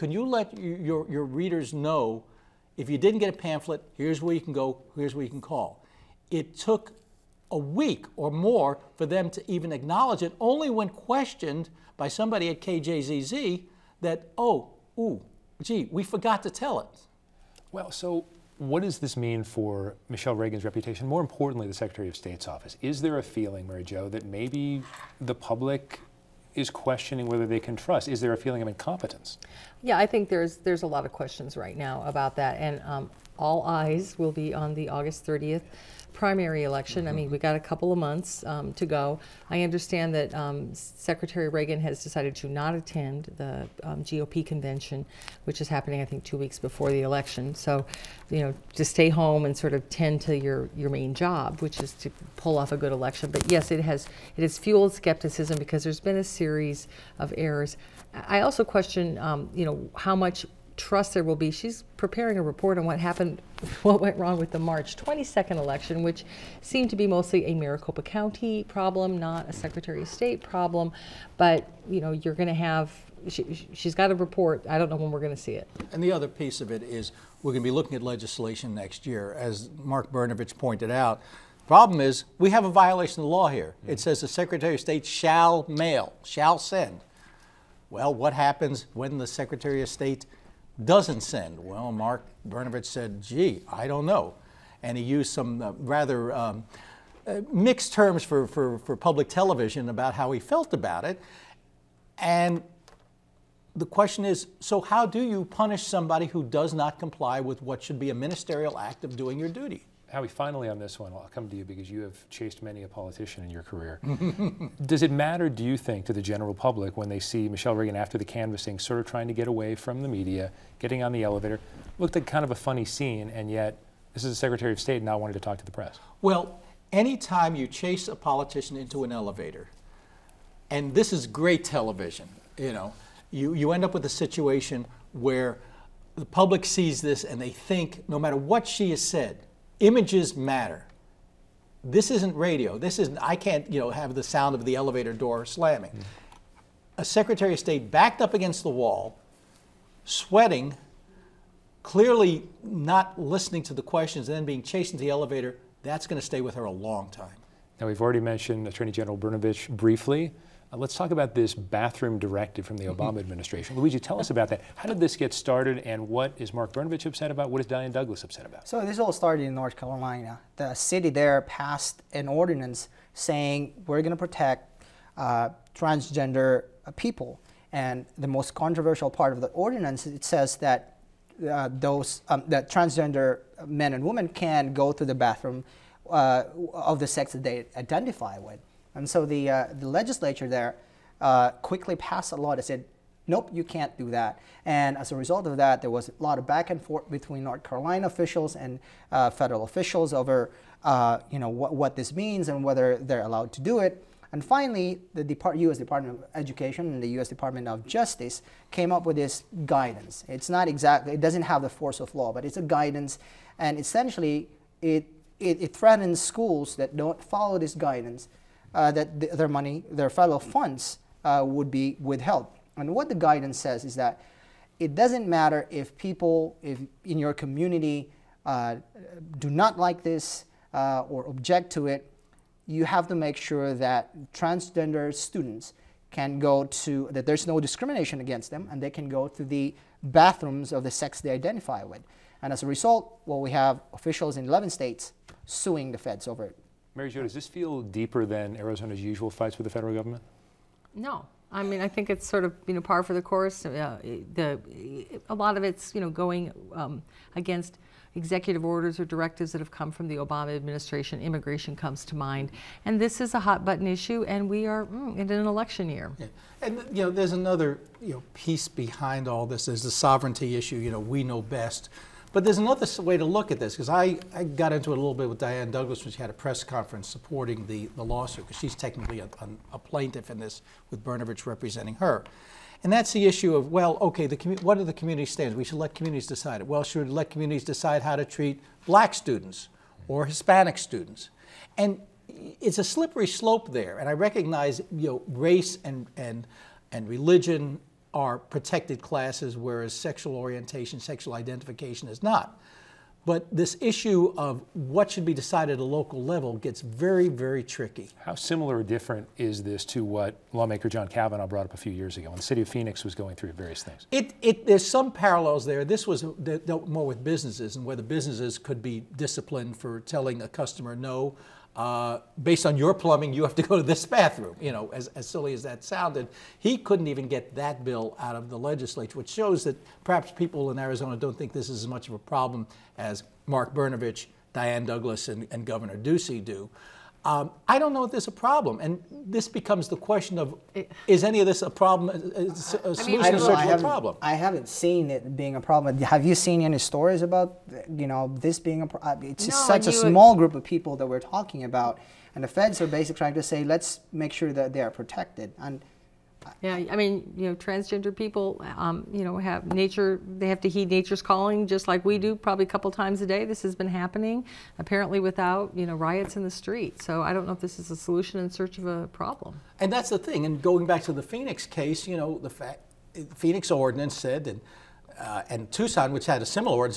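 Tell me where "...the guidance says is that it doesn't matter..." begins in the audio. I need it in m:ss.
3:43.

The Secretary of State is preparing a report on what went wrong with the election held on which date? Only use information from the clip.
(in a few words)
March 22nd.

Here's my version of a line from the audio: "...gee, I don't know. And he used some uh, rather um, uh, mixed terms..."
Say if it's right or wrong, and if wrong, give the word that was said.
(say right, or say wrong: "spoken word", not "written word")
right.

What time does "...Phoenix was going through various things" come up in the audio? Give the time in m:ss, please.
5:12.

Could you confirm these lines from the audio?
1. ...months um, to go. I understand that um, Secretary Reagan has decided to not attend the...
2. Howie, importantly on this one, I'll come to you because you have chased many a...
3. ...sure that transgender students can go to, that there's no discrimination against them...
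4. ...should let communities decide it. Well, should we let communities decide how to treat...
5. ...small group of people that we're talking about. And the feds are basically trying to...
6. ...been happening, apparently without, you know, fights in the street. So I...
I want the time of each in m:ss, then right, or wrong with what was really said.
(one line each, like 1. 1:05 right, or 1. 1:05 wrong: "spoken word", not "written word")
1. 0:37 right
2. 1:50 wrong: "finally", not "importantly"
3. 3:53 right
4. 4:45 right
5. 5:49 right
6. 6:03 wrong: "riots", not "fights".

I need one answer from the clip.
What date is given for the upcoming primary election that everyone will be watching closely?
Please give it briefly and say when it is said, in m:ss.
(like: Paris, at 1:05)
August 30th, at 0:34.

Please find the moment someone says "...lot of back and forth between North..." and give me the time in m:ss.
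3:16.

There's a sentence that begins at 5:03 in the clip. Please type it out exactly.
But this issue of what should be decided at a local level gets very, very tricky.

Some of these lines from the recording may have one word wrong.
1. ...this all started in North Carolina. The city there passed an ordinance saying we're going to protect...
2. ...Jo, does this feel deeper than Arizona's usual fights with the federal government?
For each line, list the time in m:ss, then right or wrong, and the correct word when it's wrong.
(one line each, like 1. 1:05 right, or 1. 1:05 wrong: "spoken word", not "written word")
1. 2:48 right
2. 4:07 right.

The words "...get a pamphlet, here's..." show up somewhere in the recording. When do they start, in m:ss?
0:03.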